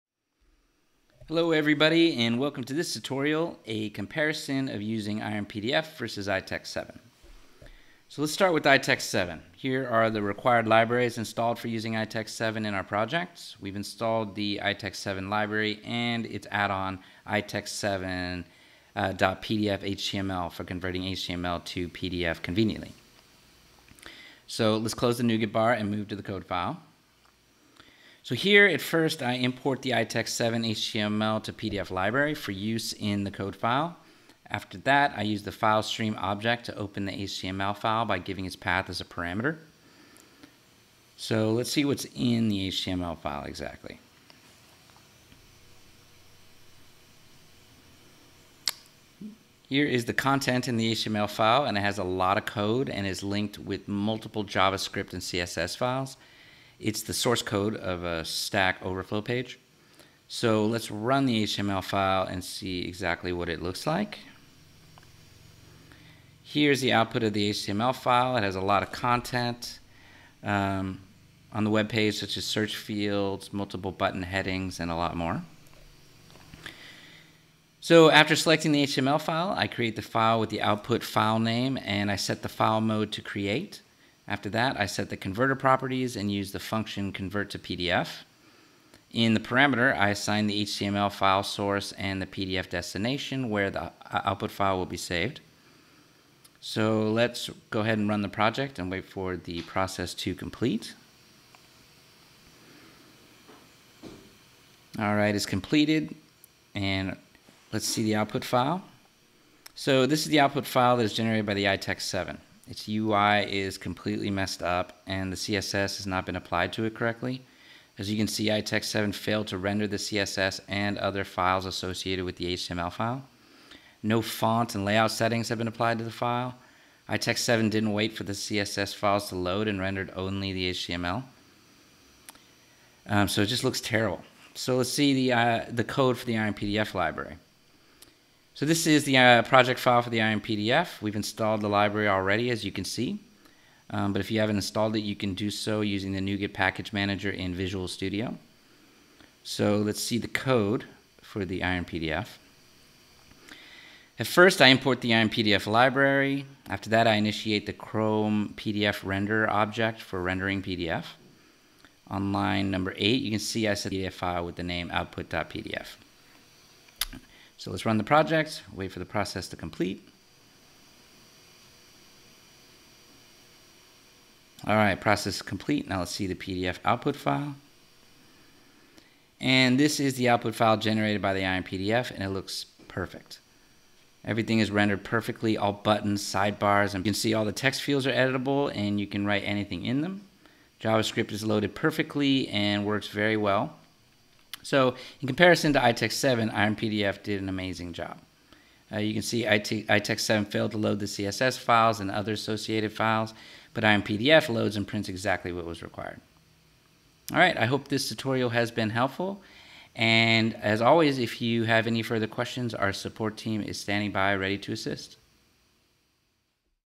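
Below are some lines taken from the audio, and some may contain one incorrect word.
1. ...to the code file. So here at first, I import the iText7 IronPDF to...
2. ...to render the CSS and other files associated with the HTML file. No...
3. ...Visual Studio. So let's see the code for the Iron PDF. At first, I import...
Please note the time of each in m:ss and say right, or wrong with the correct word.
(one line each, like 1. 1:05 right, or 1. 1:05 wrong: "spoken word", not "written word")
1. 0:26 wrong: "HTML", not "IronPDF"
2. 1:59 right
3. 2:27 right.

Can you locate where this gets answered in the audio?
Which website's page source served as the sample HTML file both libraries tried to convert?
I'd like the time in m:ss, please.
0:58.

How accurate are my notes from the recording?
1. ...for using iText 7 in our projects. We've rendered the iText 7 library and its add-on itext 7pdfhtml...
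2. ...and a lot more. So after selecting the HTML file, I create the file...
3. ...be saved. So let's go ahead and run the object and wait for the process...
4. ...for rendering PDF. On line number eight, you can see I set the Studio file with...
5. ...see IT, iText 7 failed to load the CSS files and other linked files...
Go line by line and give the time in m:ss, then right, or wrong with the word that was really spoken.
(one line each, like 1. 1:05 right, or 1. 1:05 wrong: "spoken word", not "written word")
1. 0:11 wrong: "installed", not "rendered"
2. 1:14 right
3. 1:34 wrong: "project", not "object"
4. 2:40 wrong: "PDF", not "Studio"
5. 3:19 wrong: "associated", not "linked".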